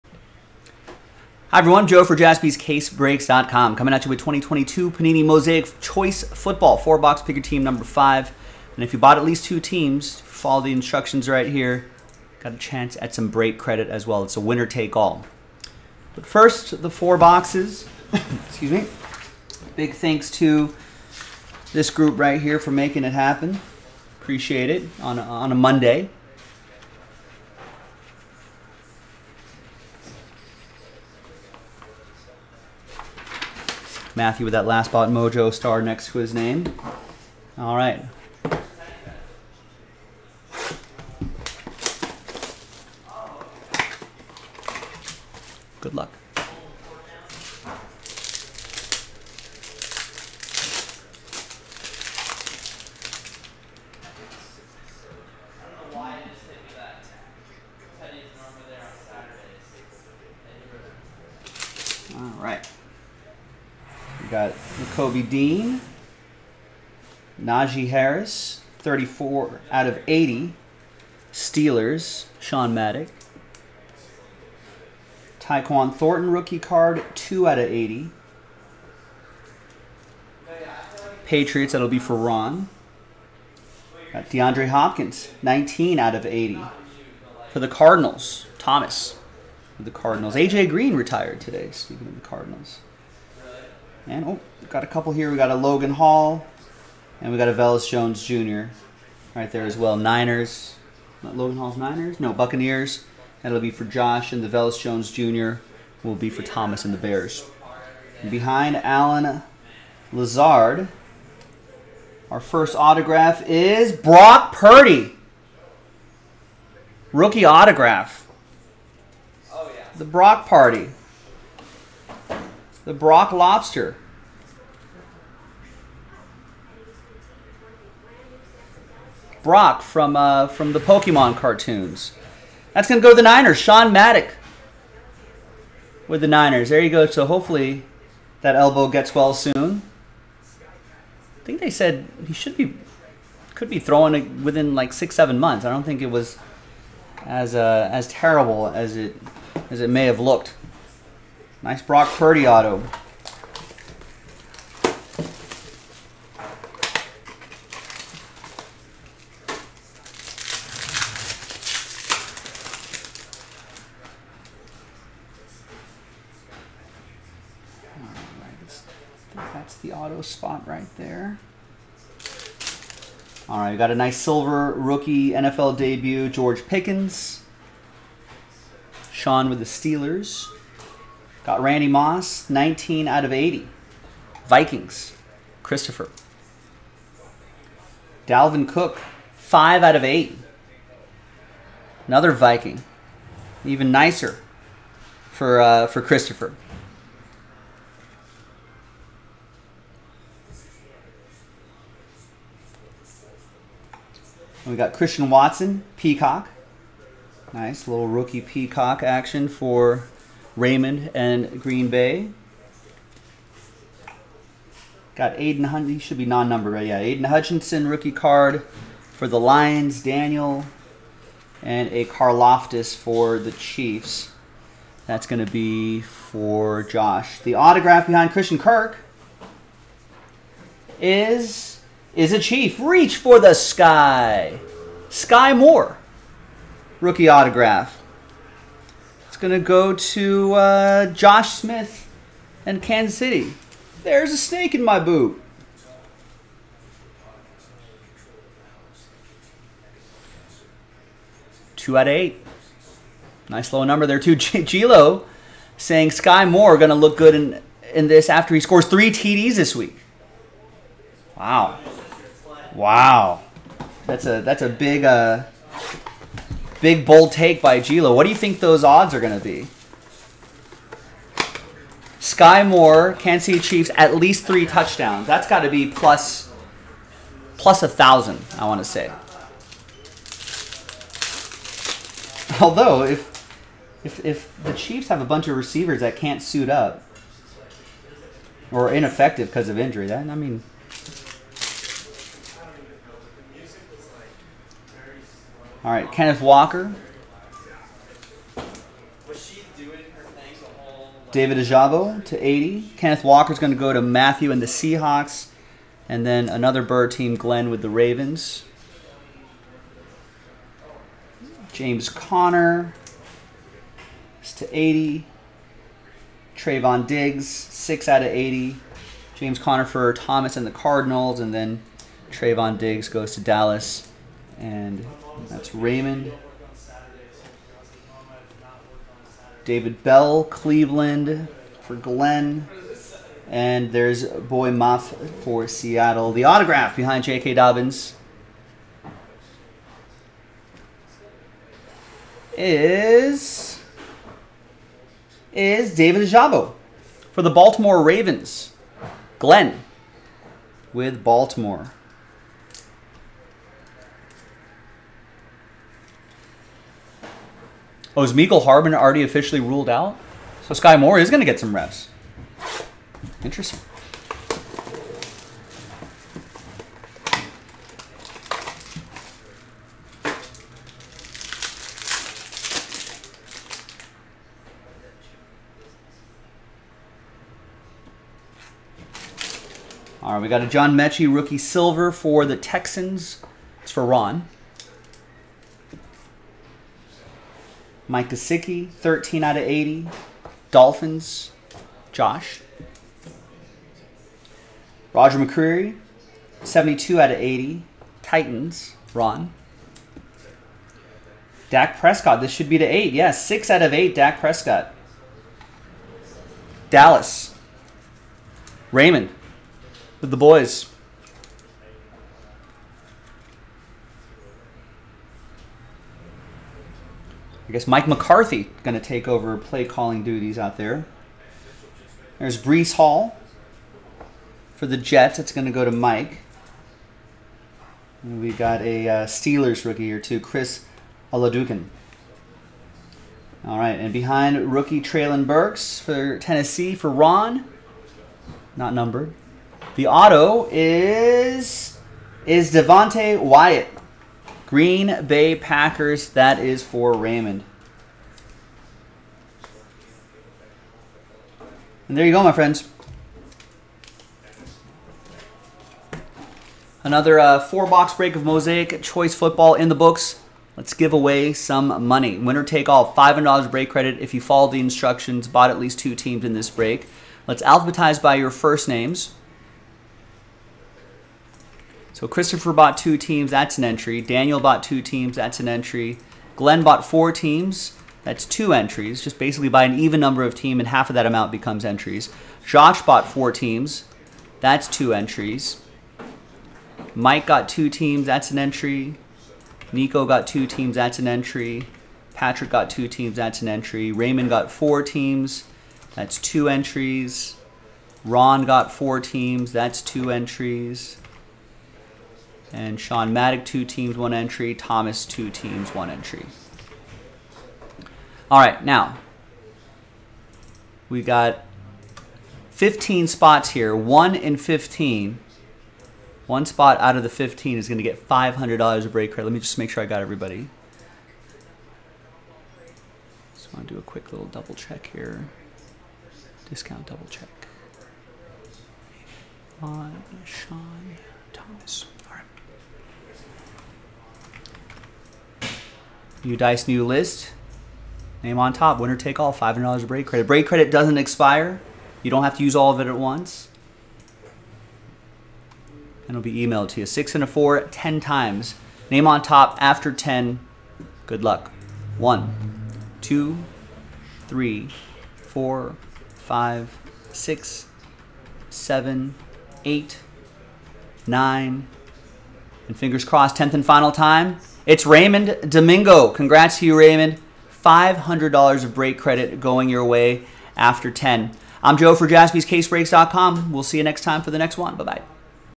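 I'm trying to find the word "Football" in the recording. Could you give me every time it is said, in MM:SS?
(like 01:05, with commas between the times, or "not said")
00:06, 07:39.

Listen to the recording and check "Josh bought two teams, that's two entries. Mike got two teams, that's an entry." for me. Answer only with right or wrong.
wrong.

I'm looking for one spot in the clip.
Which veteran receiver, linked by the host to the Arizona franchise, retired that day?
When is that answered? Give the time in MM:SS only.
01:30.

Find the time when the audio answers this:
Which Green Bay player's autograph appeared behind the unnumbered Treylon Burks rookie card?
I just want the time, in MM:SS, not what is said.
07:22.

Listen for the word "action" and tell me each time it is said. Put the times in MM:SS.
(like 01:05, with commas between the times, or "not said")
03:29.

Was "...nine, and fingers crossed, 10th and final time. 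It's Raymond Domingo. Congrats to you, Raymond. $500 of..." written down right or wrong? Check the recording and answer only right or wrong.
right.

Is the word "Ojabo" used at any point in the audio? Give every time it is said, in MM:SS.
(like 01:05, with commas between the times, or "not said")
05:01, 05:46.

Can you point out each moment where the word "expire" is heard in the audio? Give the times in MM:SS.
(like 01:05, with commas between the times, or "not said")
09:01.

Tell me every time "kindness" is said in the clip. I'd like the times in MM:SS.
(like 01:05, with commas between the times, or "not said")
not said.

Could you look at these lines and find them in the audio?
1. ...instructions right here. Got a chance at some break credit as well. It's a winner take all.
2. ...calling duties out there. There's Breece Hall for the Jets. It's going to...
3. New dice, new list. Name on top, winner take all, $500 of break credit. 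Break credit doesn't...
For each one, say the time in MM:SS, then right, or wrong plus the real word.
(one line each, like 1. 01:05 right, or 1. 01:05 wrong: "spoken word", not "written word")
1. 00:10 right
2. 06:59 right
3. 08:56 right.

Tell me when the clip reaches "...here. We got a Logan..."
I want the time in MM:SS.
01:35.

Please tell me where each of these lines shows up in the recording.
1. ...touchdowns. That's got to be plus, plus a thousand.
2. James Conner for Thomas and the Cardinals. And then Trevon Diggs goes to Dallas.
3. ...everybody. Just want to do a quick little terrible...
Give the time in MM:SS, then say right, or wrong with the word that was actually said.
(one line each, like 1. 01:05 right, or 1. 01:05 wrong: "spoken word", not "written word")
1. 04:34 right
2. 05:19 right
3. 08:40 wrong: "double", not "terrible".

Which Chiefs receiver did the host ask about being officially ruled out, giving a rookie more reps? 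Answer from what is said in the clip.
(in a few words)
Mecole Hardman.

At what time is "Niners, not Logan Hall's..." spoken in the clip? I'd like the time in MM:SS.
01:39.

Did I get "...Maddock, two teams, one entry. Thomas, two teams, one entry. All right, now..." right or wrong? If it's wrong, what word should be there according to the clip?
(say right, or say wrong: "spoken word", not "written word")
right.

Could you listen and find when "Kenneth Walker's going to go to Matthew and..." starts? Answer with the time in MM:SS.
05:02.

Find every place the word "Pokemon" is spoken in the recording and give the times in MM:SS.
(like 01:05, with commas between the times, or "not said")
02:10.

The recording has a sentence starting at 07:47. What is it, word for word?
Let's alphabetize by your first names.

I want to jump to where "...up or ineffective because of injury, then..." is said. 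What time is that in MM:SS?
04:46.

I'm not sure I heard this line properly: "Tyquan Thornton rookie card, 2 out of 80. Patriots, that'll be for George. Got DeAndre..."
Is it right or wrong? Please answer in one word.
wrong.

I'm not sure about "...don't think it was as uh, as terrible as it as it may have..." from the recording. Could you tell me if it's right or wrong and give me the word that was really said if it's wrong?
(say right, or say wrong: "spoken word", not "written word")
right.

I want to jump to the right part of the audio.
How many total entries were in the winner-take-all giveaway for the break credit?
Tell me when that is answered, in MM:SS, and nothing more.
08:32.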